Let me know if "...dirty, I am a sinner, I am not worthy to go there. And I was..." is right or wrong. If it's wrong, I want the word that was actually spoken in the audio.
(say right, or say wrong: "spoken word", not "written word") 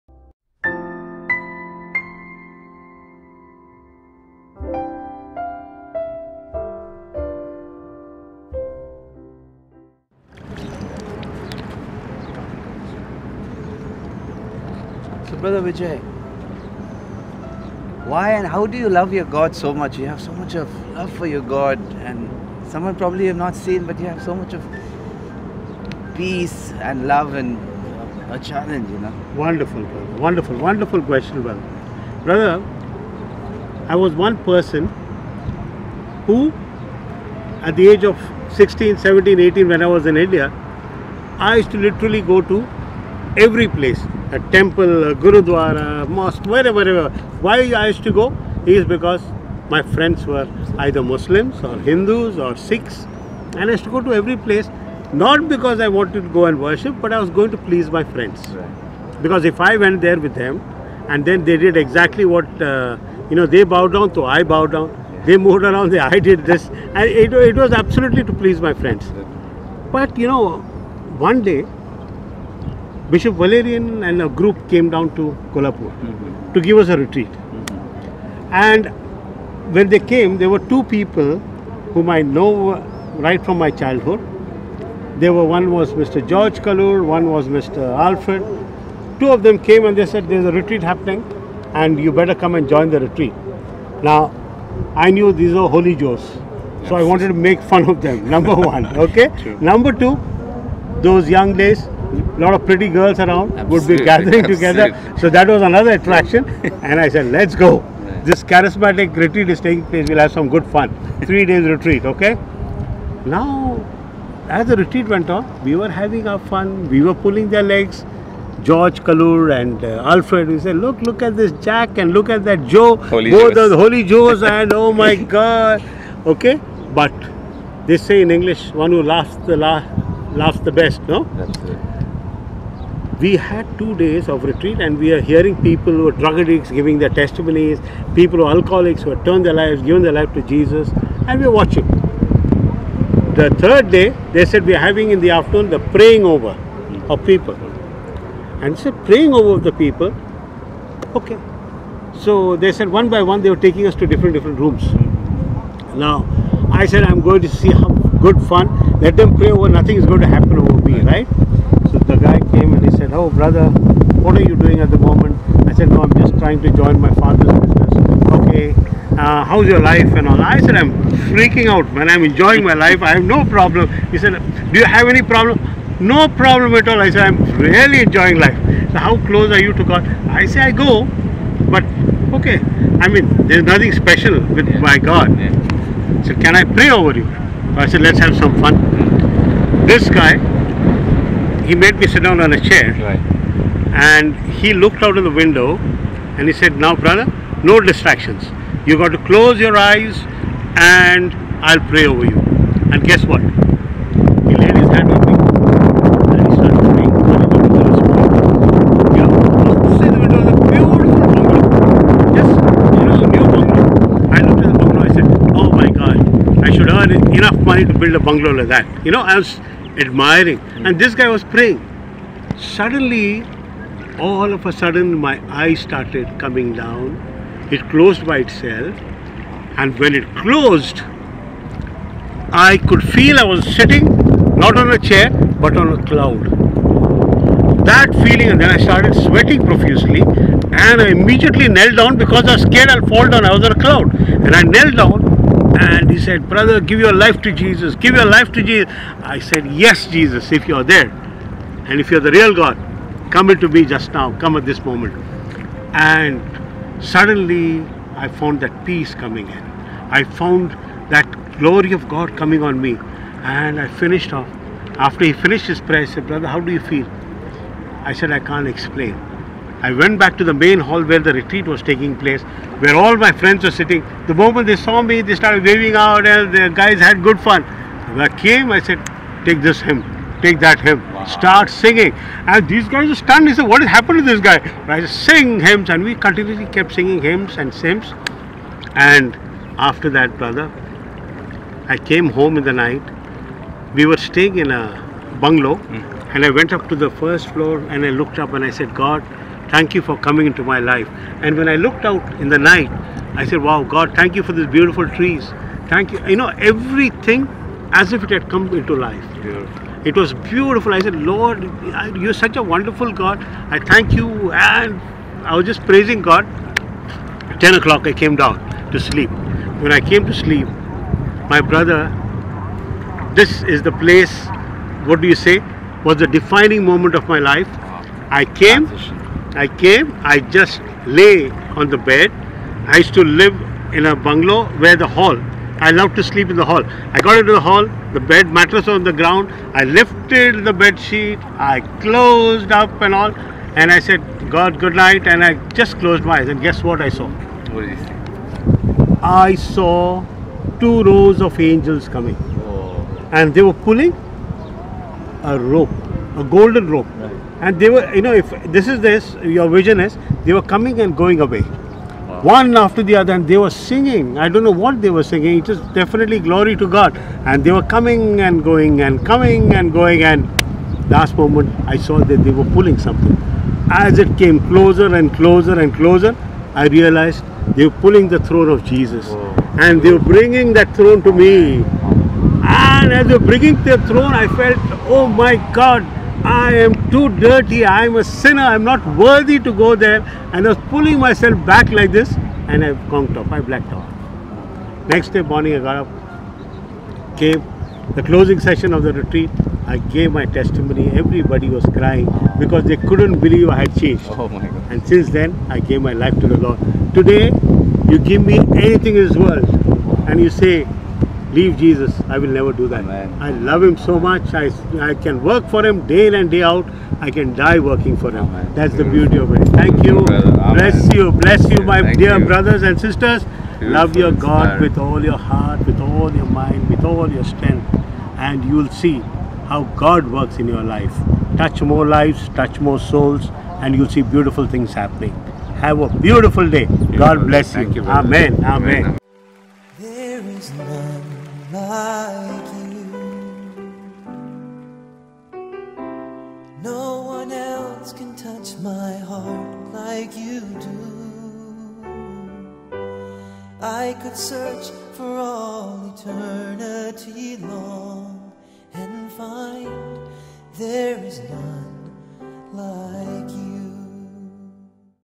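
right.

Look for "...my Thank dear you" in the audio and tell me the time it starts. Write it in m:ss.
7:01.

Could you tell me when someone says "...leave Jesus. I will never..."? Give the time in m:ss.
6:51.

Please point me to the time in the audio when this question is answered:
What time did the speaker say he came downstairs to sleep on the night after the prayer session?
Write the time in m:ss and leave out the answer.
5:17.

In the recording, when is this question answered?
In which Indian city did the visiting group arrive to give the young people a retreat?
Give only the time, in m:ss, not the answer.
1:15.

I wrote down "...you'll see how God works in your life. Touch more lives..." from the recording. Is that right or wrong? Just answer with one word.
right.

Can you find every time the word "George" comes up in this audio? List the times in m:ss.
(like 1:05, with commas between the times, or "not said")
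1:26, 1:58.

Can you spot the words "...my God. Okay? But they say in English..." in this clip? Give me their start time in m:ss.
2:04.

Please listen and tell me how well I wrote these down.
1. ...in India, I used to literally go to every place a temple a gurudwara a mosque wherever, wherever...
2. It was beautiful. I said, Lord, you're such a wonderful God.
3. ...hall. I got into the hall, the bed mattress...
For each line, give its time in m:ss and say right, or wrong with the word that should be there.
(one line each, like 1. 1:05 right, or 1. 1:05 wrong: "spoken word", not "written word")
1. 0:40 right
2. 5:10 right
3. 5:36 right.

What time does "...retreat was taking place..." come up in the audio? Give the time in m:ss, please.
4:31.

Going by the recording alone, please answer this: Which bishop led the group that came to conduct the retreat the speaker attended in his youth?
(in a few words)
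Bishop Valerian.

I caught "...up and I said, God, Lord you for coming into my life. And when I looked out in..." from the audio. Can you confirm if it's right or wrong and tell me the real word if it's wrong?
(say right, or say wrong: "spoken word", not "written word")
wrong: "Thank", not "Lord".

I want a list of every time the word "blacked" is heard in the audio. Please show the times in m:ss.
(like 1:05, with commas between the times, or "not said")
6:33.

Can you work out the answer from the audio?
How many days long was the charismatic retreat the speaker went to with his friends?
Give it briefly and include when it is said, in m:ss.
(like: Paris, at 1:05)
3, at 1:51.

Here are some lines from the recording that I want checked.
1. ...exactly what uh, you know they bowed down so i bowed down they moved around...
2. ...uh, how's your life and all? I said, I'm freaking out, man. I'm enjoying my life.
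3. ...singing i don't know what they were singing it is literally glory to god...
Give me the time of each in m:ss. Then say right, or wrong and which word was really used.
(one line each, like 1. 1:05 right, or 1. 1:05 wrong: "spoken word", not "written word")
1. 1:01 right
2. 2:49 right
3. 6:03 wrong: "definitely", not "literally".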